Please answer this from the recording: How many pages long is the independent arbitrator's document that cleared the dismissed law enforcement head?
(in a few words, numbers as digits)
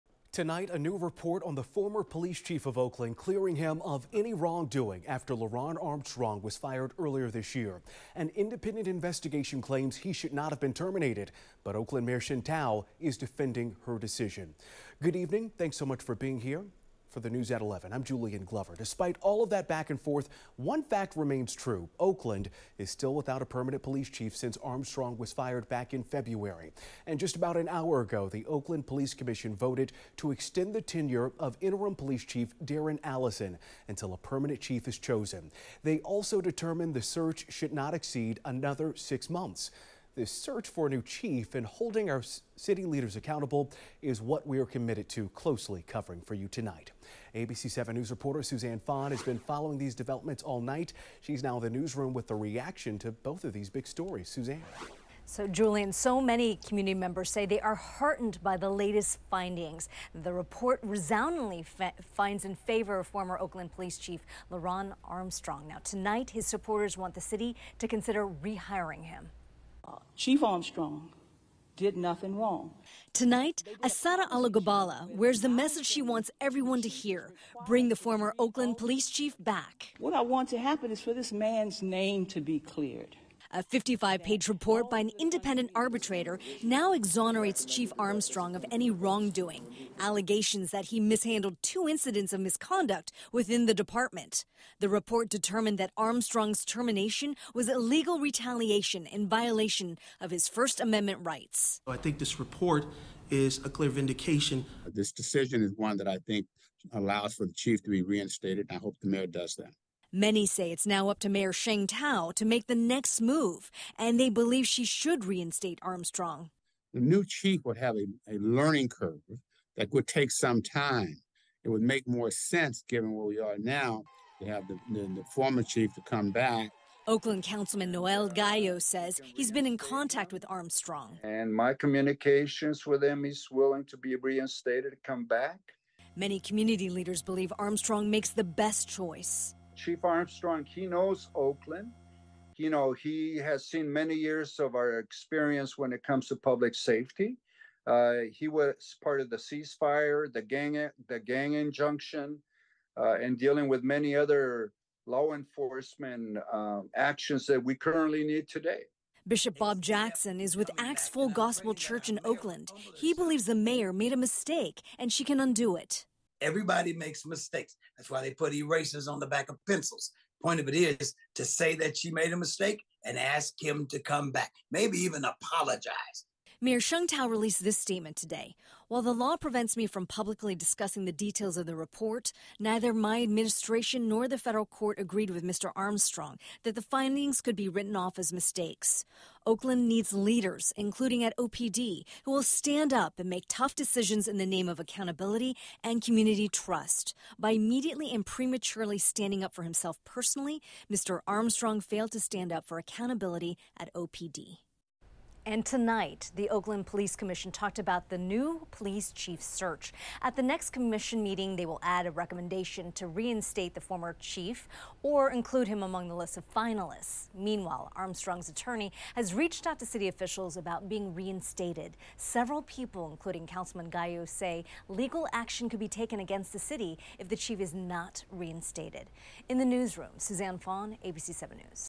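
55.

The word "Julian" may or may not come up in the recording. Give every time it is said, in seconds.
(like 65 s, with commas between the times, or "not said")
18 s, 55 s.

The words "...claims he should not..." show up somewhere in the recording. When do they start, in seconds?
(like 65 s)
9 s.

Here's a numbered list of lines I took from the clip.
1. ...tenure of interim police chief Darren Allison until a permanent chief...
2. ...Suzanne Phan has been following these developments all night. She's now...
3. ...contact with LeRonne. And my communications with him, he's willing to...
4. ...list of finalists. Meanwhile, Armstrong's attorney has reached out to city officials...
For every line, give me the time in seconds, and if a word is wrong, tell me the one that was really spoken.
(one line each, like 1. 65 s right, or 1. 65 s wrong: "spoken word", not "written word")
1. 30 s right
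2. 48 s right
3. 129 s wrong: "Armstrong", not "LeRonne"
4. 216 s right.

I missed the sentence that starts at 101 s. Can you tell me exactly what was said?
I think this report is a clear vindication.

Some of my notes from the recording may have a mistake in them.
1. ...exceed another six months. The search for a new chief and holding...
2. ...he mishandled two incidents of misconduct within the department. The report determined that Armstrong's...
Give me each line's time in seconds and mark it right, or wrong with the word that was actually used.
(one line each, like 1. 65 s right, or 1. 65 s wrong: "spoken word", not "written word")
1. 37 s right
2. 90 s right.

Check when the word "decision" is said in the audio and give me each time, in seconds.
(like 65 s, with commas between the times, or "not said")
13 s, 105 s, 193 s.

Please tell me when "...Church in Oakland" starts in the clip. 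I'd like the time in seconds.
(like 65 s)
161 s.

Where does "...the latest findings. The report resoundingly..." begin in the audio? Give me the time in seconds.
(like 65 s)
58 s.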